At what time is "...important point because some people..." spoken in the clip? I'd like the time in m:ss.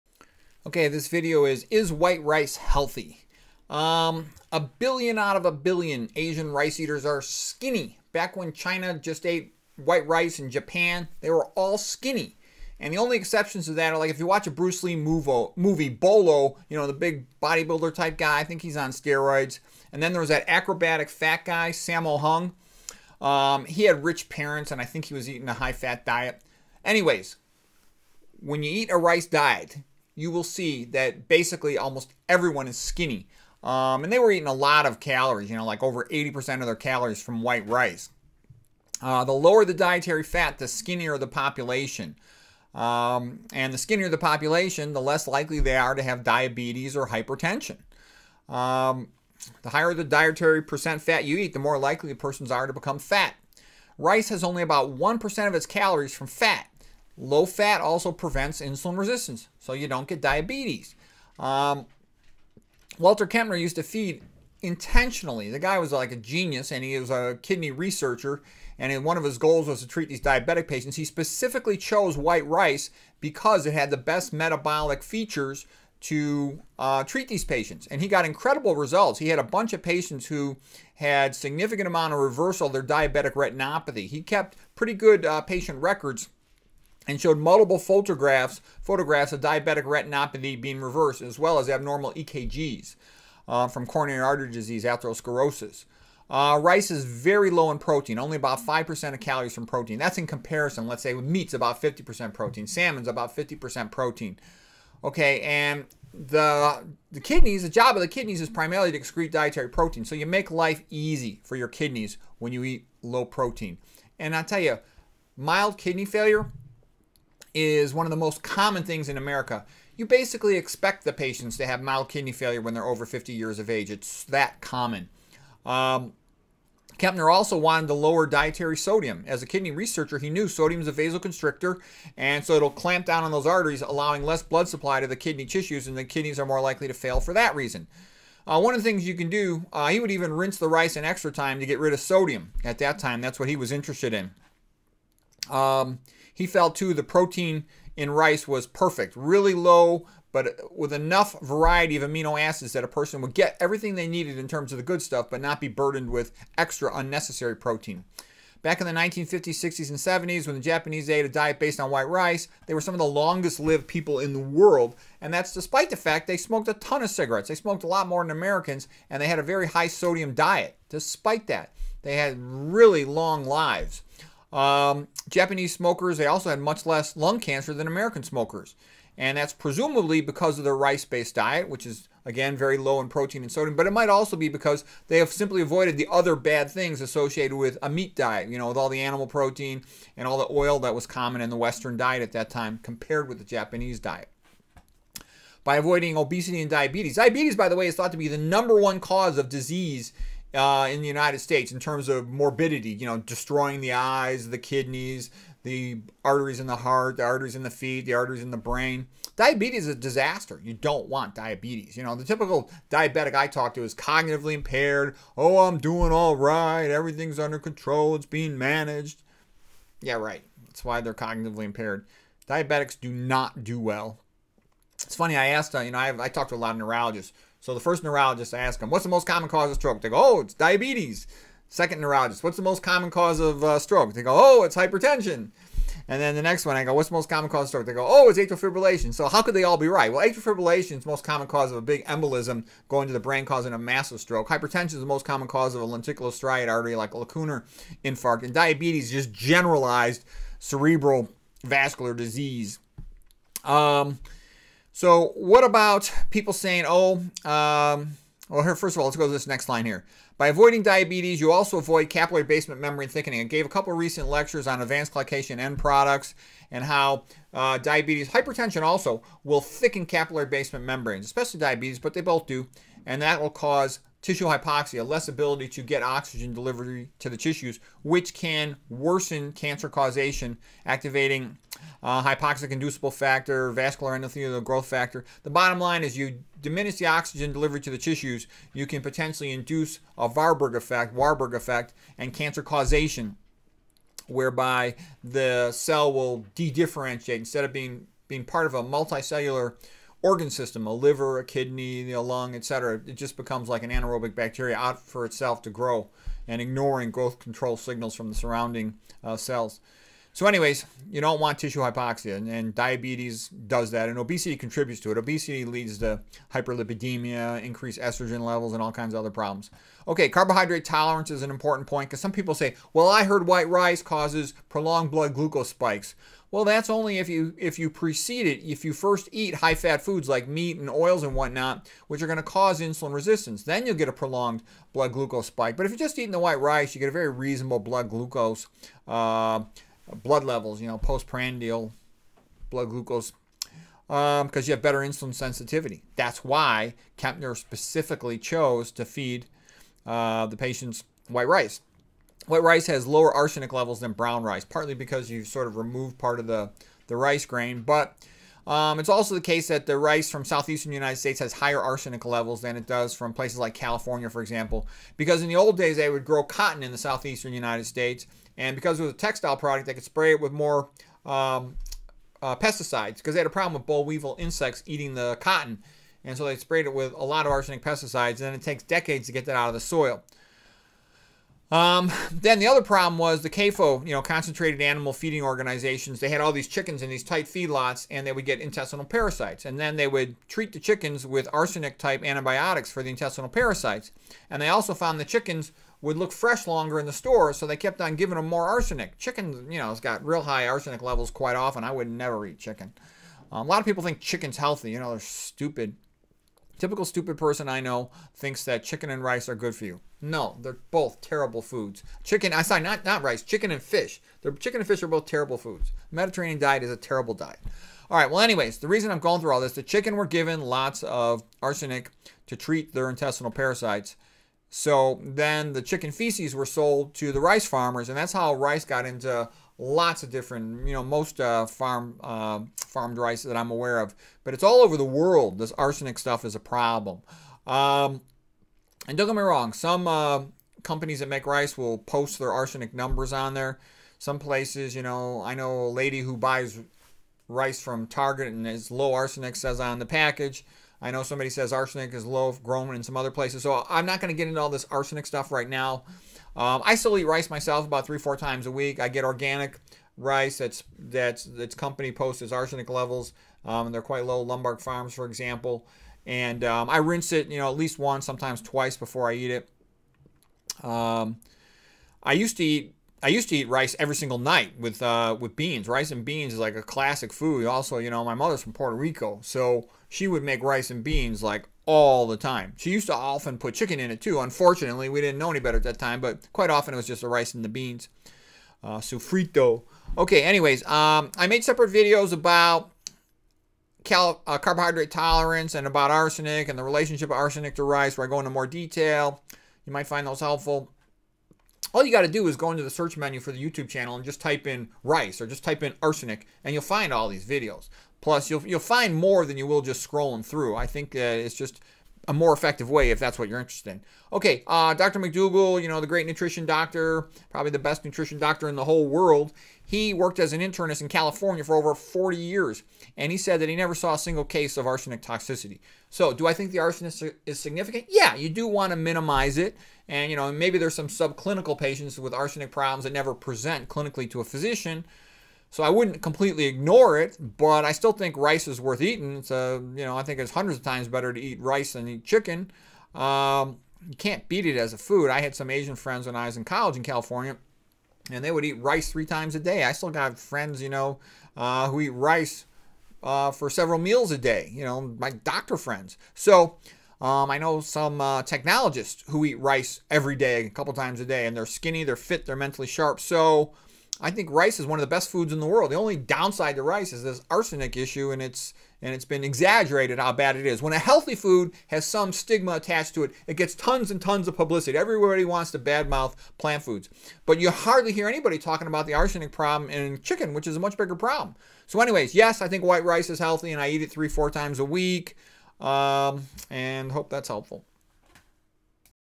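5:21.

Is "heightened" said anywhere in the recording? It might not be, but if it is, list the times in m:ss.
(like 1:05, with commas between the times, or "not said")
not said.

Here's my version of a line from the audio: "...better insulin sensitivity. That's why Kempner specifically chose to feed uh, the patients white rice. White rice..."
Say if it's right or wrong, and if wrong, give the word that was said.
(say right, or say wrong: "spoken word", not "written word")
right.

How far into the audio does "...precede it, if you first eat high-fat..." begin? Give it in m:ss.
5:27.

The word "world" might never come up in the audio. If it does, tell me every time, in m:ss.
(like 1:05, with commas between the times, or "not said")
2:44, 7:15, 8:39, 9:25.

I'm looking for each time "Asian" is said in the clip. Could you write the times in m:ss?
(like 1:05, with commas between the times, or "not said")
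0:06, 9:05.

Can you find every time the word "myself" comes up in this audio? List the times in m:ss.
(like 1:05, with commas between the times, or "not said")
7:37.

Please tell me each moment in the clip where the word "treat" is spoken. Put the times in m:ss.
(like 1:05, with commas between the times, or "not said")
1:09, 1:17, 6:30, 7:02.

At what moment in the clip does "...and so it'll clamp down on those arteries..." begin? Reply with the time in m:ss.
2:12.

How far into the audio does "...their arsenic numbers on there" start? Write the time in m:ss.
7:22.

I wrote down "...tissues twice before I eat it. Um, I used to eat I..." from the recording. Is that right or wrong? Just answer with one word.
wrong.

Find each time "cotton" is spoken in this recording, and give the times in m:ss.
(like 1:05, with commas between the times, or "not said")
6:06, 6:15.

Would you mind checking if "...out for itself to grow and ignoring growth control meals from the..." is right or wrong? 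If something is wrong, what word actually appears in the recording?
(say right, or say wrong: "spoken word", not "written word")
wrong: "signals", not "meals".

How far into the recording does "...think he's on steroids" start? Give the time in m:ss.
0:18.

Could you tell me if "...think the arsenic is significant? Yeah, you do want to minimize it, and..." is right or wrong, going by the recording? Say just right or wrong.
right.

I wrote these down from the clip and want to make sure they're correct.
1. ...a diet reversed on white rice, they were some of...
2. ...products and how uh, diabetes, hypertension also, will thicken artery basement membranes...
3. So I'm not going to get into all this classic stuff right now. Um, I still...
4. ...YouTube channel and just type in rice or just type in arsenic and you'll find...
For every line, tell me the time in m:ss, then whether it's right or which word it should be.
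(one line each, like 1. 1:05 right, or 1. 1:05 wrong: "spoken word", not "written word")
1. 2:41 wrong: "based", not "reversed"
2. 4:25 wrong: "capillary", not "artery"
3. 7:33 wrong: "arsenic", not "classic"
4. 8:23 right.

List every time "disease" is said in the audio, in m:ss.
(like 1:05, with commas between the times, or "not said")
1:34, 3:19, 4:12.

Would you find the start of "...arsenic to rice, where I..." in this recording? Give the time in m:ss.
8:17.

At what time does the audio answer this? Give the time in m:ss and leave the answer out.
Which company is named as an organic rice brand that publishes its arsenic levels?
7:44.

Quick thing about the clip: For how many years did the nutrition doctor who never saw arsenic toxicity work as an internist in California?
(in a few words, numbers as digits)
over 40 years.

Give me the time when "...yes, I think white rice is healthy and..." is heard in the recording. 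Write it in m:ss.
9:42.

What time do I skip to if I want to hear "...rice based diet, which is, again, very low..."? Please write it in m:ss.
3:00.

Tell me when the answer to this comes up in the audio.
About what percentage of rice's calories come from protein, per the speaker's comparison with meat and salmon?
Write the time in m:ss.
1:38.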